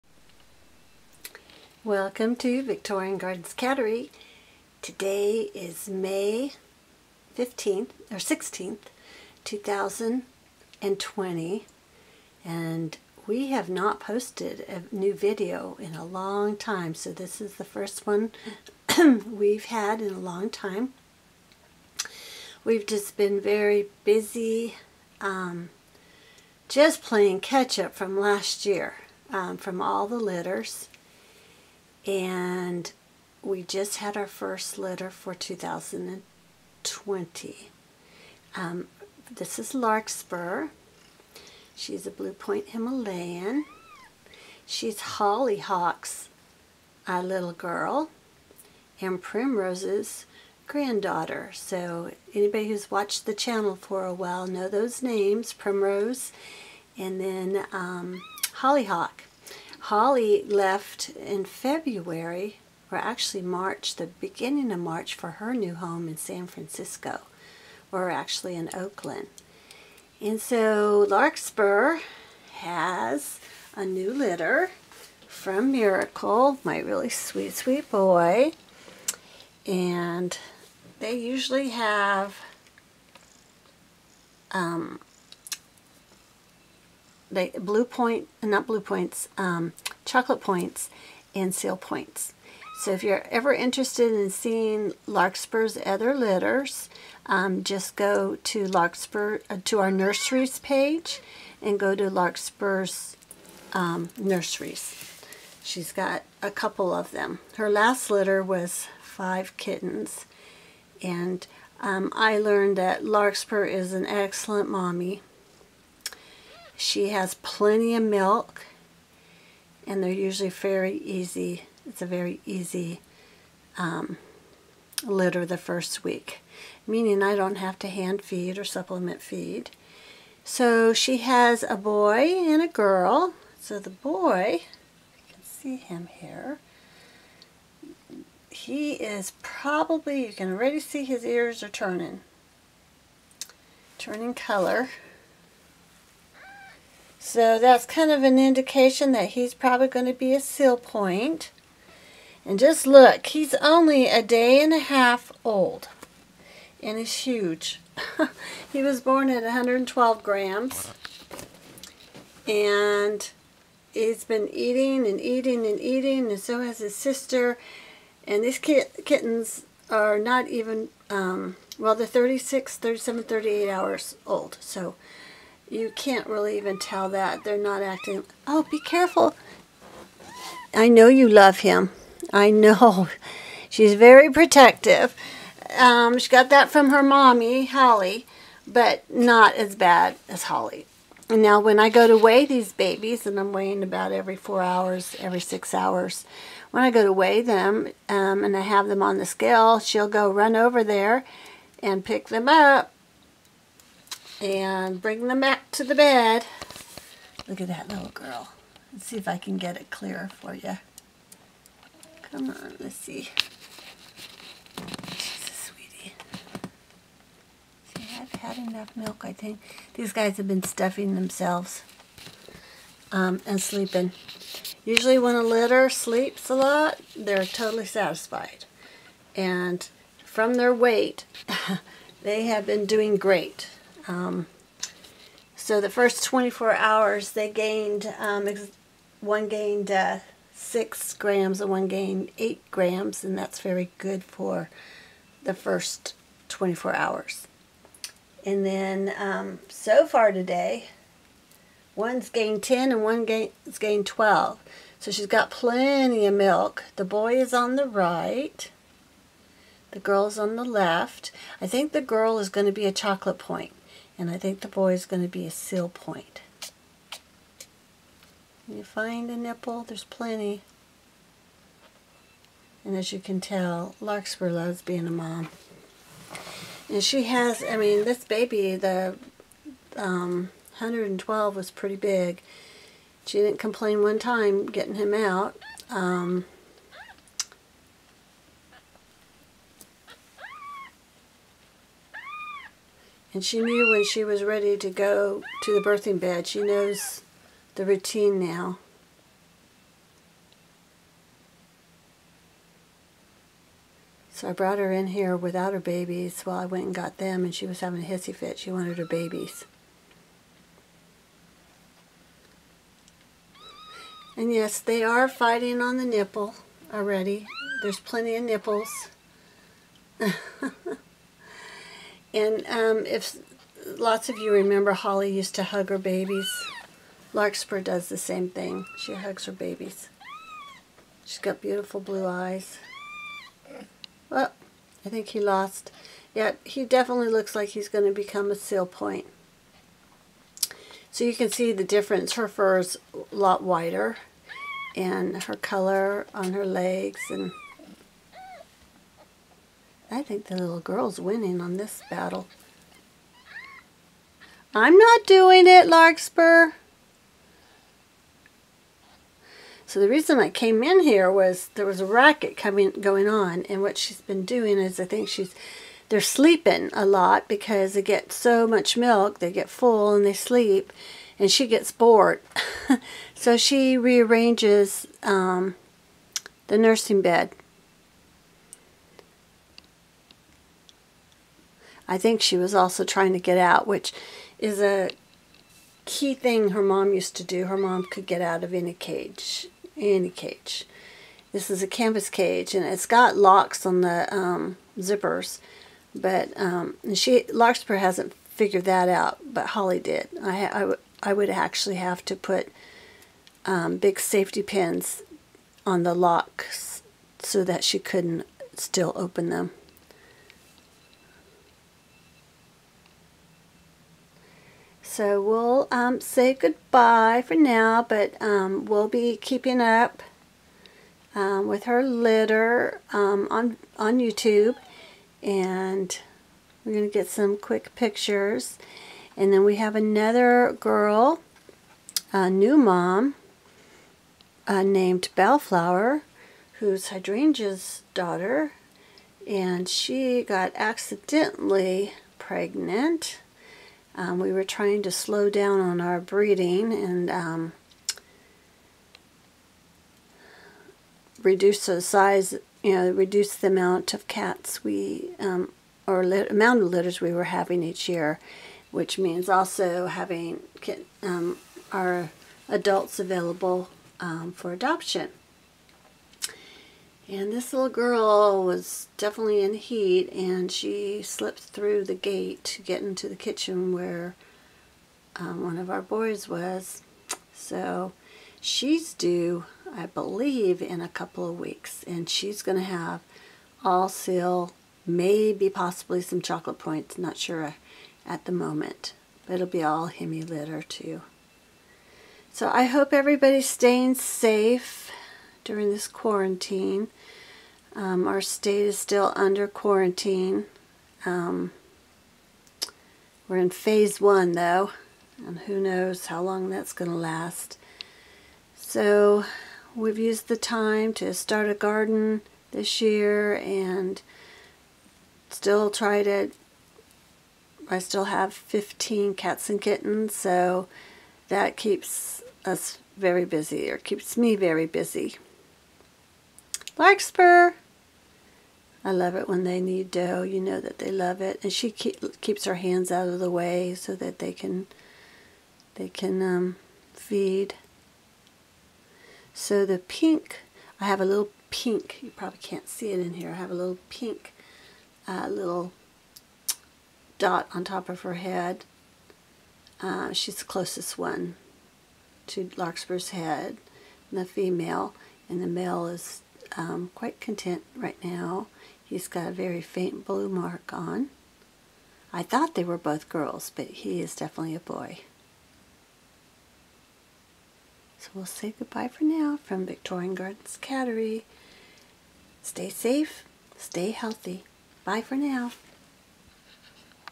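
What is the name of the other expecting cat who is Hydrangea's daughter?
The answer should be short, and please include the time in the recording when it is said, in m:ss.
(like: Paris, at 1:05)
Bellflower, at 7:15.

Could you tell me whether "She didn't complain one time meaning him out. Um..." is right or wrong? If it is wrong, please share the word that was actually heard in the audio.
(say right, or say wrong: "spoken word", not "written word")
wrong: "getting", not "meaning".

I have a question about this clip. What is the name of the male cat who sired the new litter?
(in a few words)
Miracle.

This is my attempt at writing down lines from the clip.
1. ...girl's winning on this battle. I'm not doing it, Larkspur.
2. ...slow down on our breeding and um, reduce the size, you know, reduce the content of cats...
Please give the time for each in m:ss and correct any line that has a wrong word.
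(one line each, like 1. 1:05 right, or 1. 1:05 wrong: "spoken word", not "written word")
1. 5:50 right
2. 7:25 wrong: "amount", not "content".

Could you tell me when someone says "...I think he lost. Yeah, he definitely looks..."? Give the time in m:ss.
5:35.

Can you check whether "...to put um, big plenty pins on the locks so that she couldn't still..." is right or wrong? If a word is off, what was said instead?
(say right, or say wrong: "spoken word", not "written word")
wrong: "safety", not "plenty".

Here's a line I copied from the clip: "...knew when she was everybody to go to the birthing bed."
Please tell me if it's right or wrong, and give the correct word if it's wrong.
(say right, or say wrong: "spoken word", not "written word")
wrong: "ready", not "everybody".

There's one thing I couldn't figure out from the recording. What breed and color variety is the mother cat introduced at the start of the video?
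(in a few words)
Blue Point Himalayan.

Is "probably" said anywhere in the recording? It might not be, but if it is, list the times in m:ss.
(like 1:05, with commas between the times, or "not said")
2:19, 2:29, 9:02.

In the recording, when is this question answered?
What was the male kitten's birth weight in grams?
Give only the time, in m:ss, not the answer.
2:39.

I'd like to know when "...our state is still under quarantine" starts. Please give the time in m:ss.
8:18.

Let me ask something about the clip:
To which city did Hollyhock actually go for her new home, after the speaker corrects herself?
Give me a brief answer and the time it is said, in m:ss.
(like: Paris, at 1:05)
Oakland, at 1:08.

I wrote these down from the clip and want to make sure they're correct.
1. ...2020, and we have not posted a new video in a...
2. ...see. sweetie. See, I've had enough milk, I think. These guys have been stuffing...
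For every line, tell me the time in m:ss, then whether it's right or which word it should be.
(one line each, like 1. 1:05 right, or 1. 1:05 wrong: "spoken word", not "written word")
1. 0:09 right
2. 3:32 right.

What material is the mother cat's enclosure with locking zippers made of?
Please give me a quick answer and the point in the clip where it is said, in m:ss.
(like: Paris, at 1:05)
Canvas, at 6:31.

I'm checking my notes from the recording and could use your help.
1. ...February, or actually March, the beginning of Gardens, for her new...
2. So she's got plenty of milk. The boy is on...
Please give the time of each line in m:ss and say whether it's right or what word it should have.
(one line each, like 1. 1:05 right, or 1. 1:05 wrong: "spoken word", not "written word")
1. 1:01 wrong: "March", not "Gardens"
2. 4:14 right.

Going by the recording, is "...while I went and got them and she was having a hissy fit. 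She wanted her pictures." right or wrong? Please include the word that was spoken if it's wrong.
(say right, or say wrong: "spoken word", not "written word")
wrong: "babies", not "pictures".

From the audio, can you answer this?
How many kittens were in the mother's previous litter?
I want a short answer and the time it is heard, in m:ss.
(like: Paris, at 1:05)
5, at 1:49.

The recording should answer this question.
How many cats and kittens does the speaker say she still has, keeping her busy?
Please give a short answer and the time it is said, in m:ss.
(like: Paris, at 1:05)
15, at 8:38.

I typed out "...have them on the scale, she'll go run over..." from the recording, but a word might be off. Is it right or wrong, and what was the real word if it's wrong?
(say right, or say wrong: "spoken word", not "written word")
right.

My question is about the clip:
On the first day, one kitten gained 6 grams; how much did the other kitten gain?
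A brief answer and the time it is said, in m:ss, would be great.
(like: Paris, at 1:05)
8, at 4:02.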